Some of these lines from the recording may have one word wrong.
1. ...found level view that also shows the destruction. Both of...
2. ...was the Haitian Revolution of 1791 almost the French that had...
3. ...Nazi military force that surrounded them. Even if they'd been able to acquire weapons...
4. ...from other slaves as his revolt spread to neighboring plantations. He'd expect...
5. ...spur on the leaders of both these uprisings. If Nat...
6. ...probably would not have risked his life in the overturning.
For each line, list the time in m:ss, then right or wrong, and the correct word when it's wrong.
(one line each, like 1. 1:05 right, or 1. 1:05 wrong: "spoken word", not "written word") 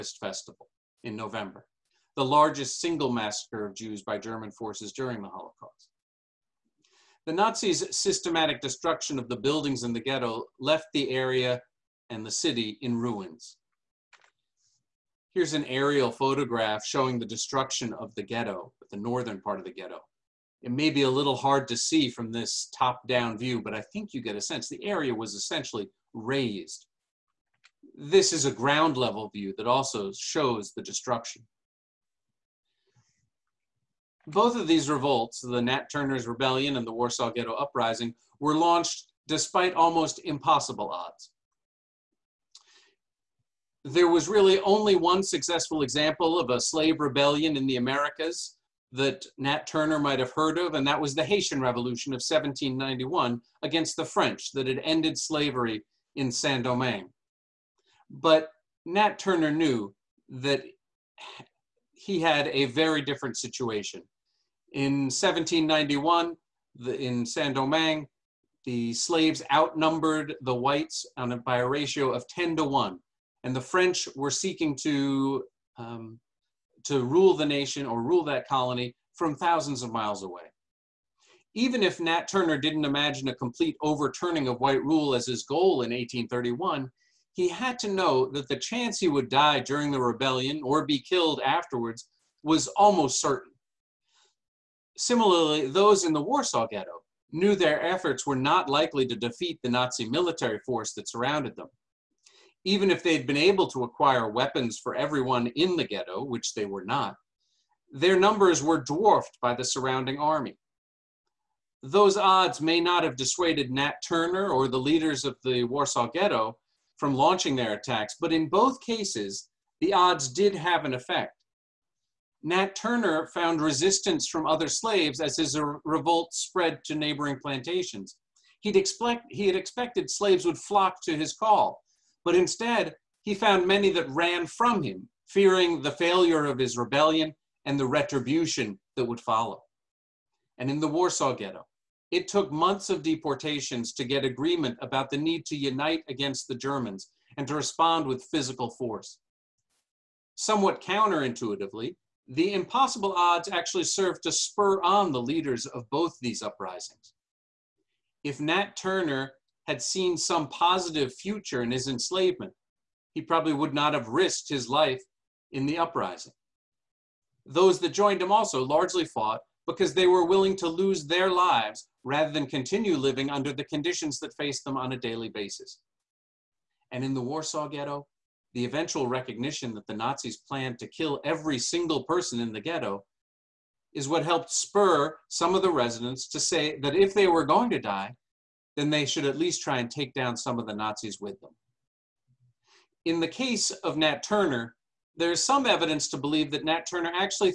1. 0:28 wrong: "ground", not "found"
2. 0:51 wrong: "against", not "almost"
3. 1:39 right
4. 2:04 right
5. 2:34 right
6. 2:43 wrong: "uprising", not "overturning".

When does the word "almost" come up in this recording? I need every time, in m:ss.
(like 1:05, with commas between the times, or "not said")
0:39, 1:32.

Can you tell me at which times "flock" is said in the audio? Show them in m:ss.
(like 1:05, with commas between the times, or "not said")
2:10.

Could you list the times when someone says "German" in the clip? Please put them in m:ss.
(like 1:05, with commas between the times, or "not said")
0:04, 2:26.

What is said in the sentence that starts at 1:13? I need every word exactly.
And the French were seeking to, um, to rule the nation or rule that colony from thousands of miles away.